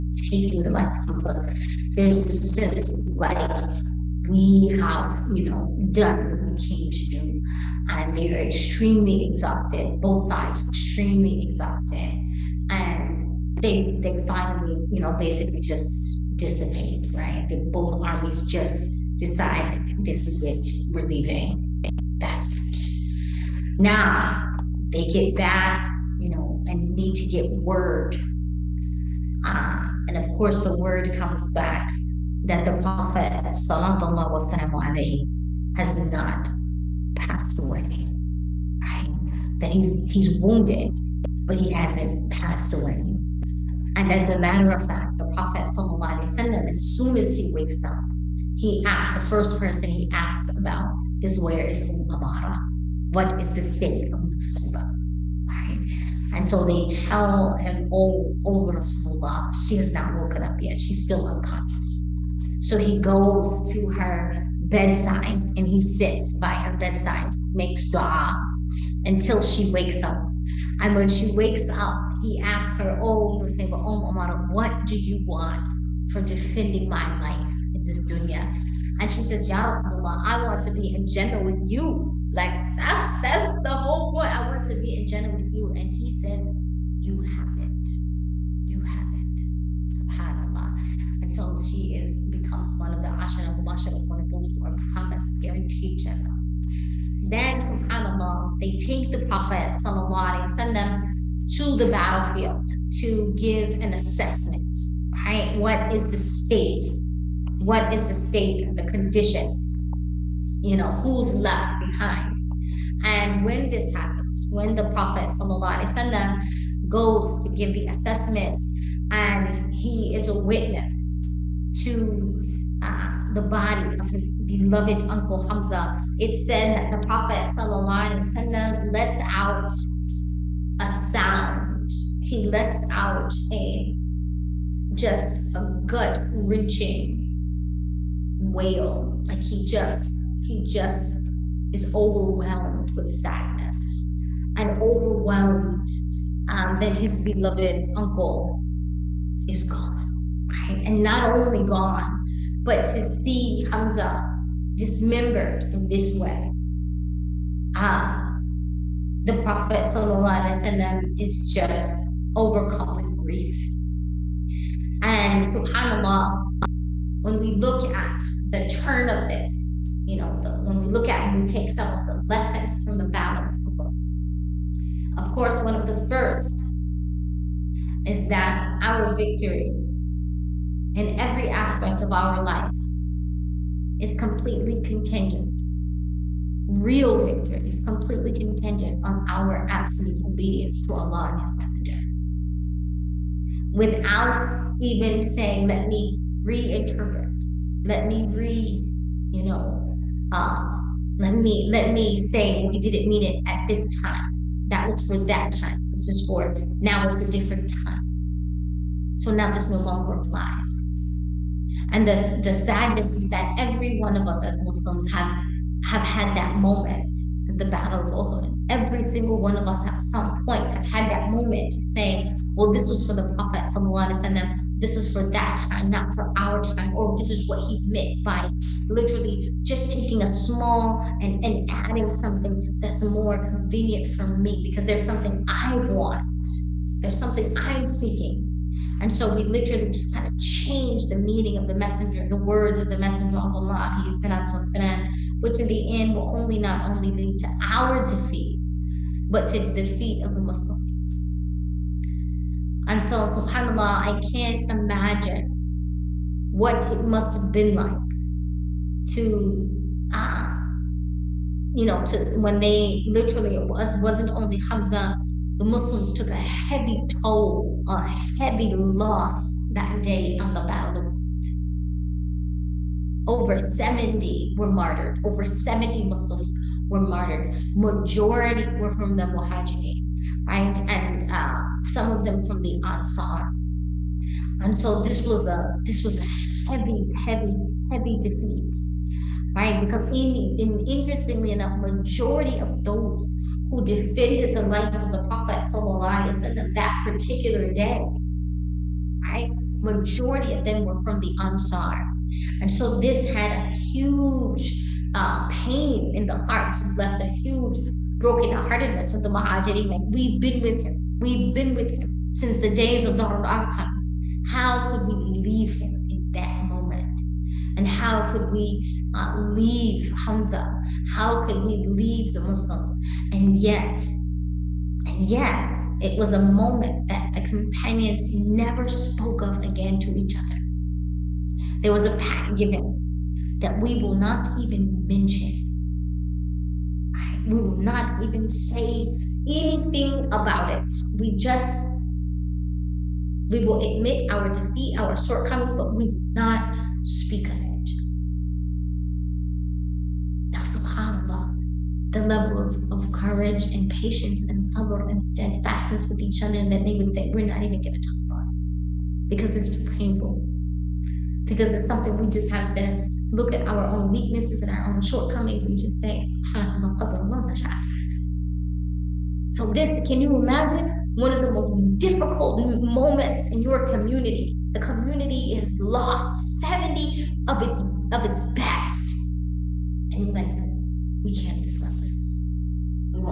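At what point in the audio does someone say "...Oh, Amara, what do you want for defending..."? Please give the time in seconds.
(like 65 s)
73 s.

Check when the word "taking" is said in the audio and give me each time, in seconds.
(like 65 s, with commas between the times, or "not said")
0 s, 229 s.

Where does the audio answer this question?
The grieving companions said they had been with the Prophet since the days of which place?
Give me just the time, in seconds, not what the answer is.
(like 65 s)
313 s.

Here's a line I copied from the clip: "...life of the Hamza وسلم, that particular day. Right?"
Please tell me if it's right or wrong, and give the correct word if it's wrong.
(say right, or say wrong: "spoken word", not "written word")
wrong: "Prophet", not "Hamza".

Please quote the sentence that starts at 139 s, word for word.
Like he just, he just is overwhelmed with sadness and overwhelmed um, that his beloved uncle is gone.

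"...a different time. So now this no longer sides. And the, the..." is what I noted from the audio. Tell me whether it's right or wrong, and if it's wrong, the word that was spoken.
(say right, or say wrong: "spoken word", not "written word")
wrong: "applies", not "sides".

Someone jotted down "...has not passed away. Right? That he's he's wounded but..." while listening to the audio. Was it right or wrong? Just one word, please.
right.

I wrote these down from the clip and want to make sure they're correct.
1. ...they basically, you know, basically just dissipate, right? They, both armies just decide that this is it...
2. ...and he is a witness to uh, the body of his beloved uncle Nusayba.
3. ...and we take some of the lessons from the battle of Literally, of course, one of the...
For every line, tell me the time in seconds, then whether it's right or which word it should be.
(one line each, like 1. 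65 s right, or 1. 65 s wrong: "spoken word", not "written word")
1. 14 s wrong: "finally", not "basically"
2. 119 s wrong: "Hamza", not "Nusayba"
3. 171 s wrong: "Uhud", not "Literally".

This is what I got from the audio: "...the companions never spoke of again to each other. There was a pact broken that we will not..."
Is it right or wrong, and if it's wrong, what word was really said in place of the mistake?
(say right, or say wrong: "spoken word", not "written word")
wrong: "given", not "broken".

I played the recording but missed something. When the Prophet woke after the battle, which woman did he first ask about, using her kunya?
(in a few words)
Umm Amara.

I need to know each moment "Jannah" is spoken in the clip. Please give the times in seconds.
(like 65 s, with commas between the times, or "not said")
81 s, 85 s, 95 s.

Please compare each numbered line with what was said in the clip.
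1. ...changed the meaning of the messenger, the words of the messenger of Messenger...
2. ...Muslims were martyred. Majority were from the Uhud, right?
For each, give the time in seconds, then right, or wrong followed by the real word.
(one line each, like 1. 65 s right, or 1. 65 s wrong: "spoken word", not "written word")
1. 240 s wrong: "Allah", not "Messenger"
2. 276 s wrong: "Muhajirin", not "Uhud".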